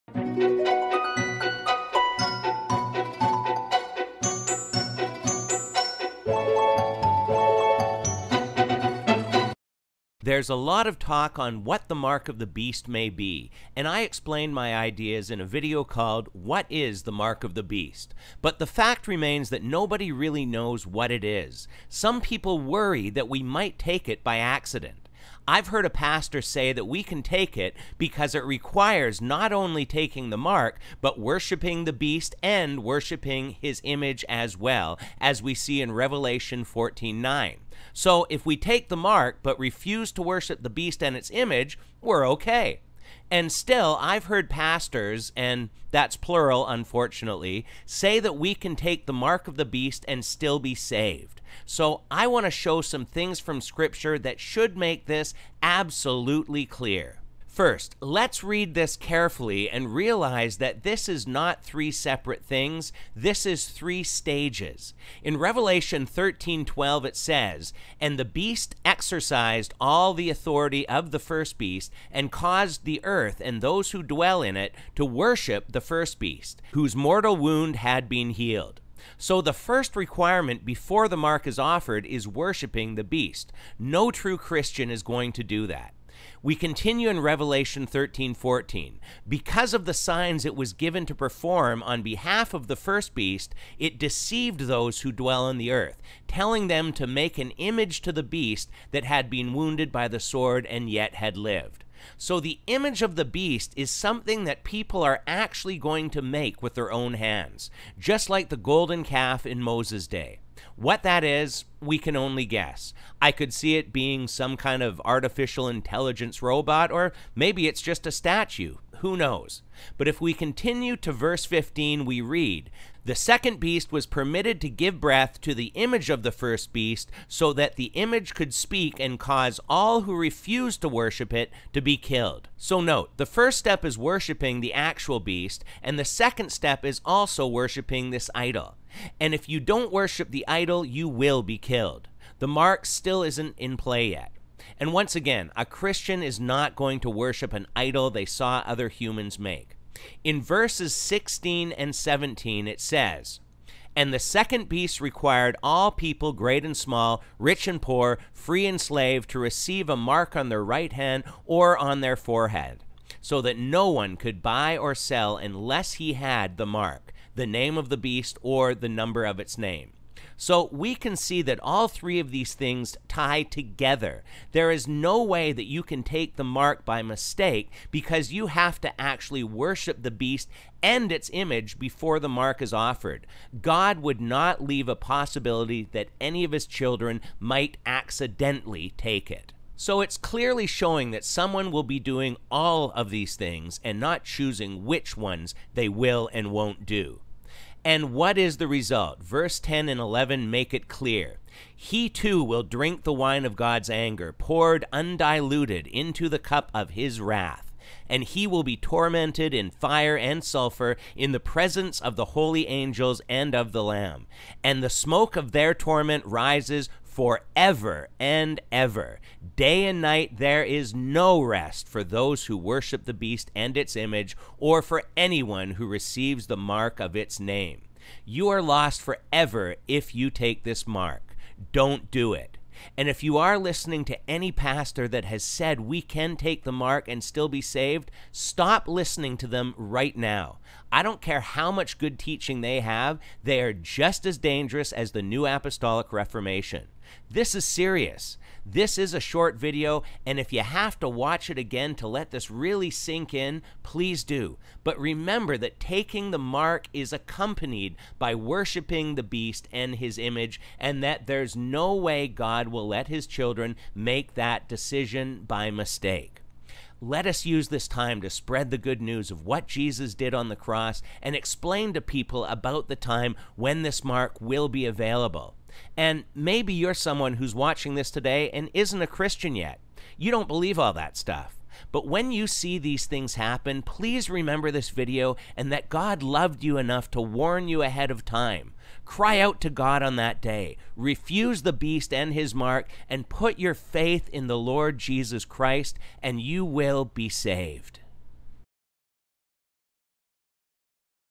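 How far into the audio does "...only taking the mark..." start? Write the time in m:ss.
0:29.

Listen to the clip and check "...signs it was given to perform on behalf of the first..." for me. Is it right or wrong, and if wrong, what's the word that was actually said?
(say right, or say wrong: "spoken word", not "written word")
right.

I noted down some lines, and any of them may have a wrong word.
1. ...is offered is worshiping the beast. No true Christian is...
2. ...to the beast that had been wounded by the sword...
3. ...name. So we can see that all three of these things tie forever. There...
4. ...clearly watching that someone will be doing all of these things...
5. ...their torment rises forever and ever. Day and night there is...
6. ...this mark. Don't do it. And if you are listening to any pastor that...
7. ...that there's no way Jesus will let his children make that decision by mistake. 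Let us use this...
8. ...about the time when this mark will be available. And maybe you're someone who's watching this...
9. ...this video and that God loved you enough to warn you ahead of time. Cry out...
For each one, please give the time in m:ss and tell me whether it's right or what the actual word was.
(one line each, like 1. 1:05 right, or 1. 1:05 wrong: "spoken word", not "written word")
1. 1:21 right
2. 1:38 right
3. 2:49 wrong: "together", not "forever"
4. 3:10 wrong: "showing", not "watching"
5. 3:35 right
6. 3:50 right
7. 4:21 wrong: "God", not "Jesus"
8. 4:32 right
9. 4:44 right.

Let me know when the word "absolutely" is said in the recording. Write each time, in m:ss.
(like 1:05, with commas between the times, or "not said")
0:55.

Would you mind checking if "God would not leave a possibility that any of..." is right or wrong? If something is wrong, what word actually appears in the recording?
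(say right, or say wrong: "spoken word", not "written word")
right.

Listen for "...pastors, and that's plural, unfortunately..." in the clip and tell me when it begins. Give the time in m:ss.
0:44.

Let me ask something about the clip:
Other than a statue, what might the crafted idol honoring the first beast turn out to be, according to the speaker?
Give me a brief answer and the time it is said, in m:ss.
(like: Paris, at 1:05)
artificial intelligence robot, at 1:55.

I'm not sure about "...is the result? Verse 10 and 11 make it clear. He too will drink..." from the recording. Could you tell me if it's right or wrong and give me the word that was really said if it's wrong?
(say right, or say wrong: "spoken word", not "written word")
right.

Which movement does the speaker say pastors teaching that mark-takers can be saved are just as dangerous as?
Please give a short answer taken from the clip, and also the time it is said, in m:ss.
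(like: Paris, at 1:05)
New Apostolic Reformation, at 4:05.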